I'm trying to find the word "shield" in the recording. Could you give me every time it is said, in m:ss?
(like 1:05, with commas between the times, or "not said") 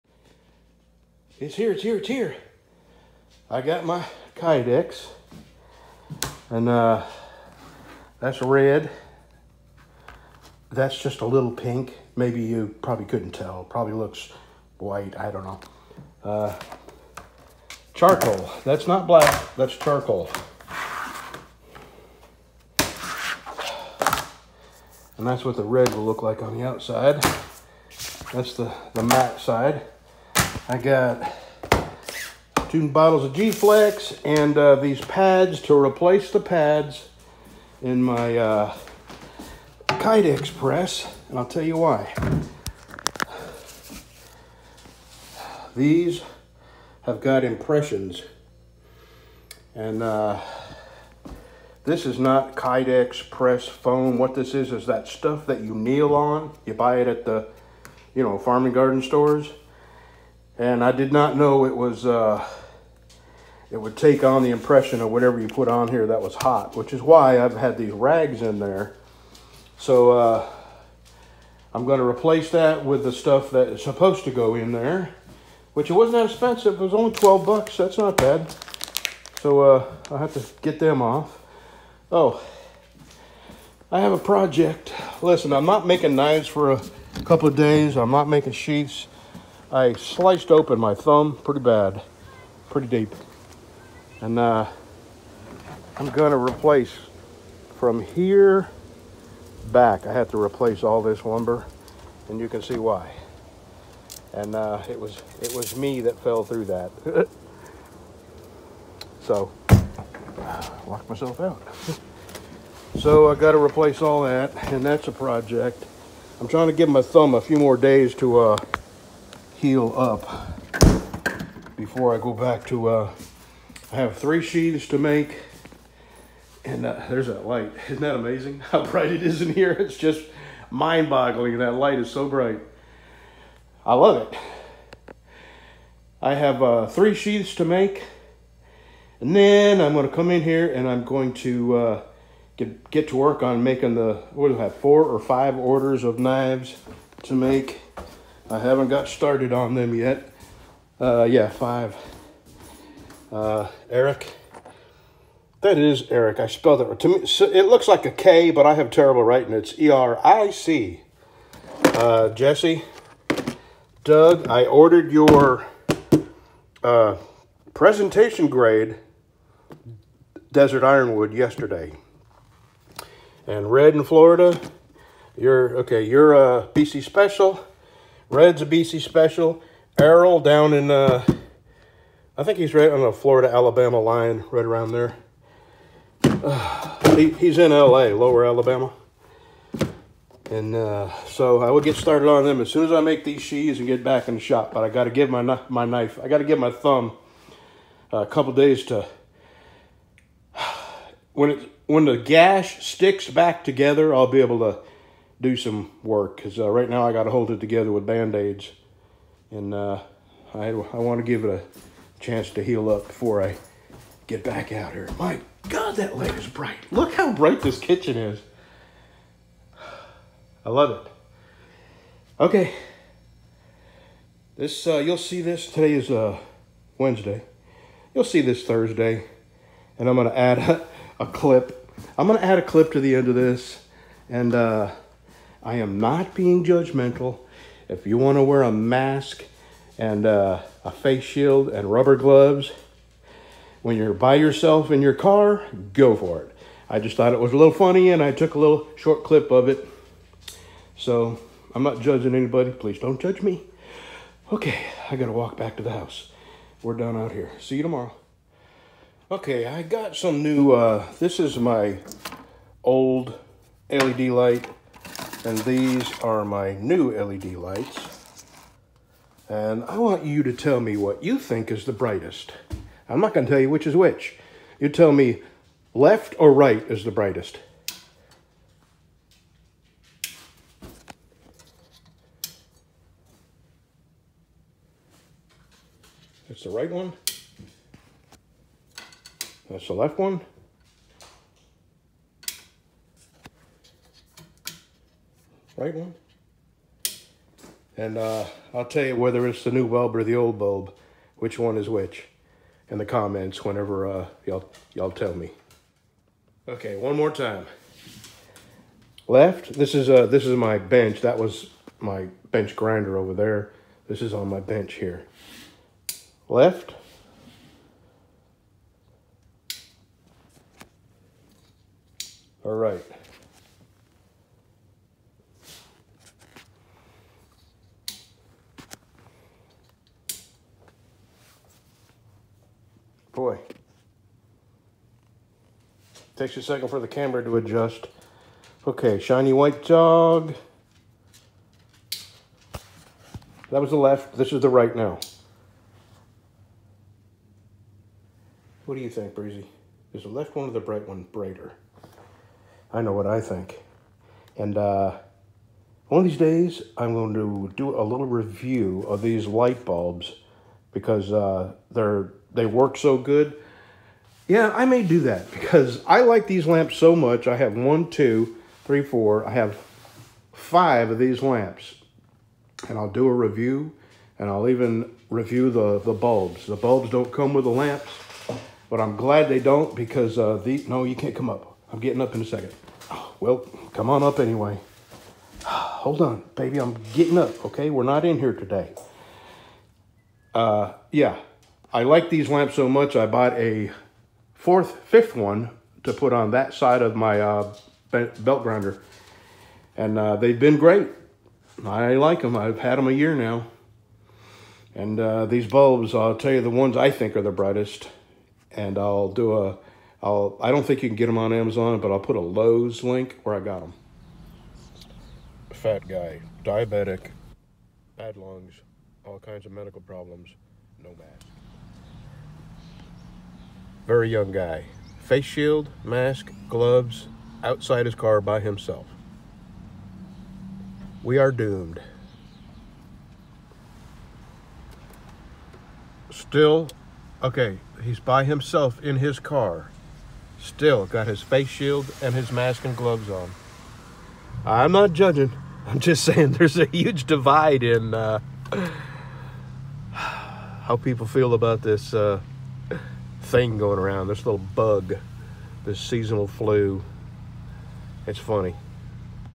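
4:01, 7:05, 7:21.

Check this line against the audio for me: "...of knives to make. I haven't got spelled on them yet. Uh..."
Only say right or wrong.
wrong.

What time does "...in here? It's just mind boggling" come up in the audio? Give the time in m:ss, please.
2:09.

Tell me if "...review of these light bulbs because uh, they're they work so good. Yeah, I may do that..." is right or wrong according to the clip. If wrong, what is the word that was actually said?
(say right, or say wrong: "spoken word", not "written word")
right.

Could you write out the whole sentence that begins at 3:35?
My God, that light is bright.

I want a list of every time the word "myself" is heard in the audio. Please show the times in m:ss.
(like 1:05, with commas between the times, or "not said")
1:51.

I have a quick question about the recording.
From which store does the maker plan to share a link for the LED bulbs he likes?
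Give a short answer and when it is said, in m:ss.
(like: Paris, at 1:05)
Lowe's, at 6:52.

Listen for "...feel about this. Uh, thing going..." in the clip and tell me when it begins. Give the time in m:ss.
7:31.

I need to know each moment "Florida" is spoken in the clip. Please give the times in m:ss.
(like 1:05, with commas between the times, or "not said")
2:54, 3:03.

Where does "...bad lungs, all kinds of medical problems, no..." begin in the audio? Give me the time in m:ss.
6:58.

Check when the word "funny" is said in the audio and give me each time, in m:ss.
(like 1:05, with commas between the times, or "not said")
4:07, 7:38.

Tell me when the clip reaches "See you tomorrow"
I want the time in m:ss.
4:17.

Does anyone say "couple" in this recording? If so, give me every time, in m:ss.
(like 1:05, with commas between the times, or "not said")
1:27, 3:18.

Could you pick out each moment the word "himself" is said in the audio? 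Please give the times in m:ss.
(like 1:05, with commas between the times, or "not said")
7:08, 7:18.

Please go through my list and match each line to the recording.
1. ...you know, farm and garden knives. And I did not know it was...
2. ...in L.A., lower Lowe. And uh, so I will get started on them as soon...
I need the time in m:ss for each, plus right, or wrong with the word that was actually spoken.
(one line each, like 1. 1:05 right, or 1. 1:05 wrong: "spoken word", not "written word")
1. 0:58 wrong: "stores", not "knives"
2. 3:07 wrong: "Alabama", not "Lowe".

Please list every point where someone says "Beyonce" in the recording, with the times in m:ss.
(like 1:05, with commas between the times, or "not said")
not said.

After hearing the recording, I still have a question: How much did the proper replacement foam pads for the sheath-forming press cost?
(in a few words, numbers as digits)
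$12.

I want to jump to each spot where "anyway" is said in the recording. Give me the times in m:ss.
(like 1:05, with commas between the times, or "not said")
6:24.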